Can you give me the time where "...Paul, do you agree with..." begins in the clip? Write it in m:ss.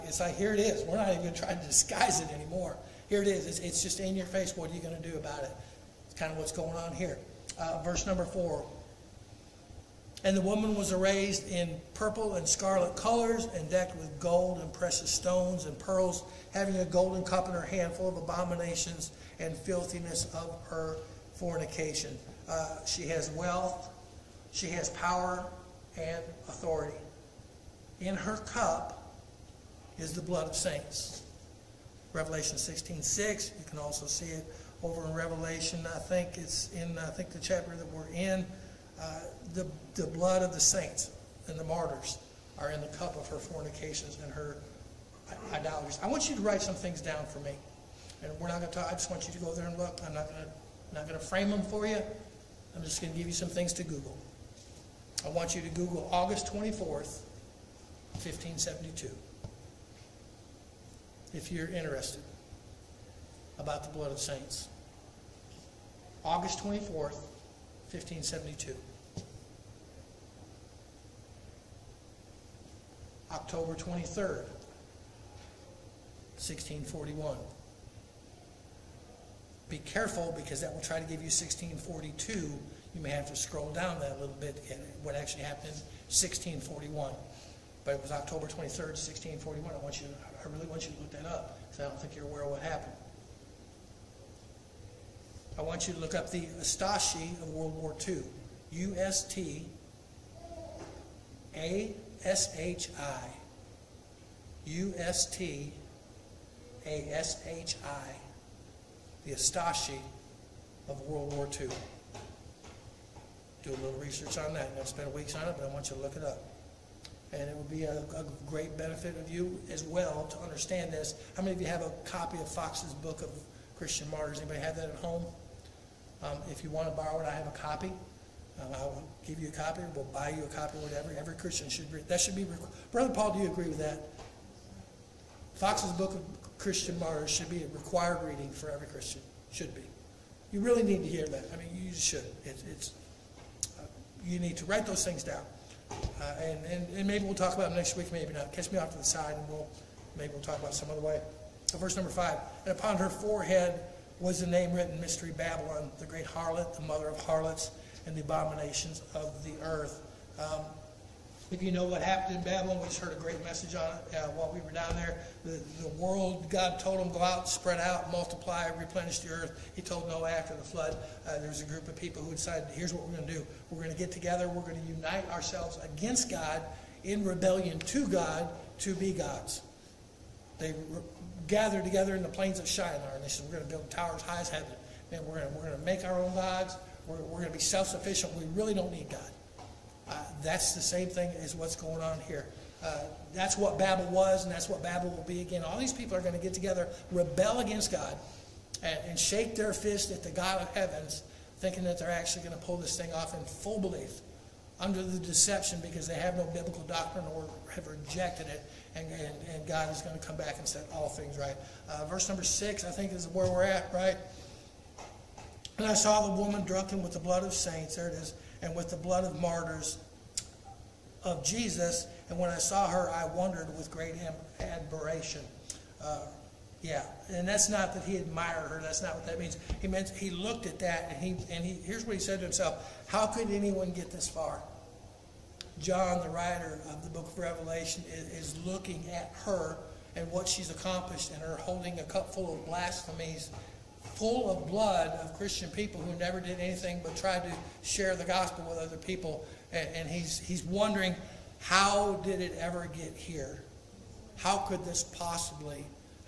2:13.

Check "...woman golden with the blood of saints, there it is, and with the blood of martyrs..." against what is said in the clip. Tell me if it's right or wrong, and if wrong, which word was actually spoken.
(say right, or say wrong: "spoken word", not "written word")
wrong: "drunken", not "golden".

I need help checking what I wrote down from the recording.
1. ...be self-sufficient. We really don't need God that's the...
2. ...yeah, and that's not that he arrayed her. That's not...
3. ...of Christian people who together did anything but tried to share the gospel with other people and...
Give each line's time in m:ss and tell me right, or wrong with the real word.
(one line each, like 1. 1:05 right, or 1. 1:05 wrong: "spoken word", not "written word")
1. 3:07 right
2. 3:46 wrong: "admired", not "arrayed"
3. 4:05 wrong: "never", not "together".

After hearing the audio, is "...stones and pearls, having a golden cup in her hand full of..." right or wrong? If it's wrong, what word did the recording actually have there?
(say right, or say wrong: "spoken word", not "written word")
right.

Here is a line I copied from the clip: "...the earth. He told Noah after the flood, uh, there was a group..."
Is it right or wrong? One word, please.
right.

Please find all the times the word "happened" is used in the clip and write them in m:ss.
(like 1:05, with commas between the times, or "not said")
1:25, 1:32, 2:42.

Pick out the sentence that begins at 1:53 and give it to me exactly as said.
Do a little research on that.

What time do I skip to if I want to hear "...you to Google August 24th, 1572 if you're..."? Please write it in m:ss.
0:55.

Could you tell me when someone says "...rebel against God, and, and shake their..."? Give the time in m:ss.
3:17.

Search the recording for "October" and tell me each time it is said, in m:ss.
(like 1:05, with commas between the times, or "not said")
1:13, 1:28.